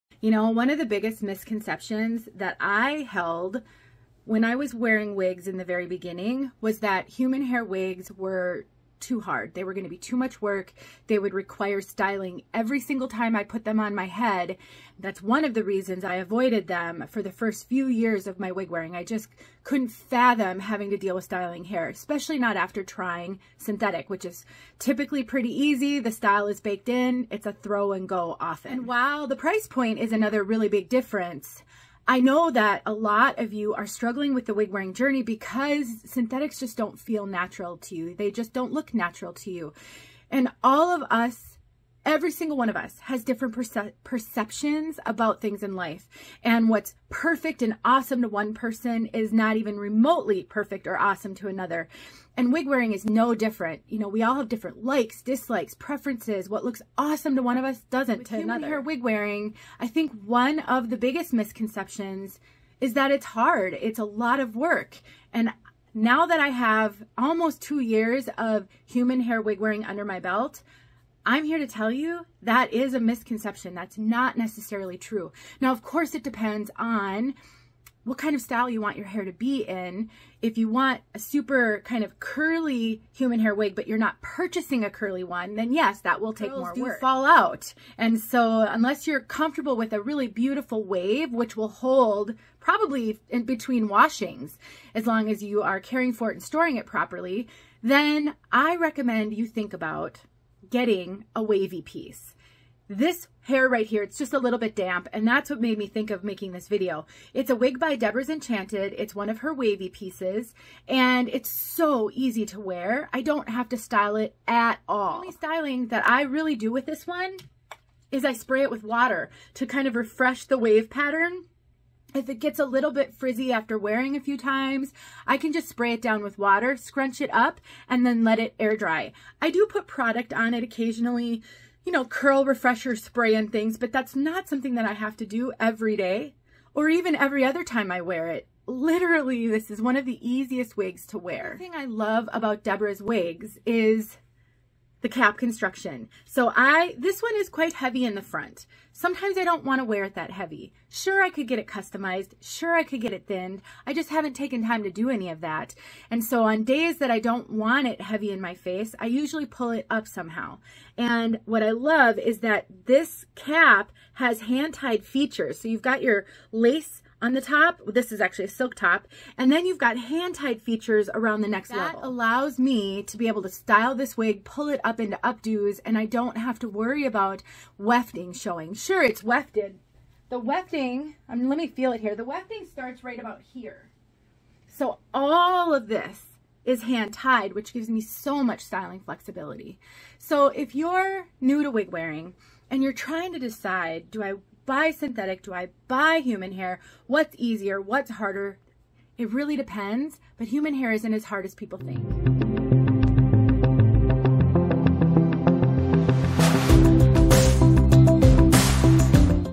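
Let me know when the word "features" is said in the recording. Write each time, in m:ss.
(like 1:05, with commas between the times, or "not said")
2:45, 2:50.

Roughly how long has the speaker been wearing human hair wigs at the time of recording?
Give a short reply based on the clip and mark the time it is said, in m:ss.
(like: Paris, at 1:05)
almost 2 years, at 1:07.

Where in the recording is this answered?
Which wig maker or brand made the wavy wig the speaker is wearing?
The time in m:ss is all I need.
1:47.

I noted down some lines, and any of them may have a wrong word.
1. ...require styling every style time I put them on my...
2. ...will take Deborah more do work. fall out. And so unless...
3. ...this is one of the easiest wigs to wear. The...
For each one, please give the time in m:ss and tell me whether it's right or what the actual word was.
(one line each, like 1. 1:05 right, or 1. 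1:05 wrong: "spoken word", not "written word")
1. 0:11 wrong: "single", not "style"
2. 1:26 wrong: "Girls", not "Deborah"
3. 2:19 right.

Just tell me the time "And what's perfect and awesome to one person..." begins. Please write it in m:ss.
0:46.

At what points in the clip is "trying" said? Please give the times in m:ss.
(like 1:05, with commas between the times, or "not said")
0:22, 3:12.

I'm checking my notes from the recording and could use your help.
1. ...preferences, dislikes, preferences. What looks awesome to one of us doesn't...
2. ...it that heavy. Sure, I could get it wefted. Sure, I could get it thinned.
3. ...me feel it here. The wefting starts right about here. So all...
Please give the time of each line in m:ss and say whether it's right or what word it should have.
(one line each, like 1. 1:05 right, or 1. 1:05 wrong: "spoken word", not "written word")
1. 0:54 wrong: "likes", not "preferences"
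2. 2:30 wrong: "customized", not "wefted"
3. 3:01 right.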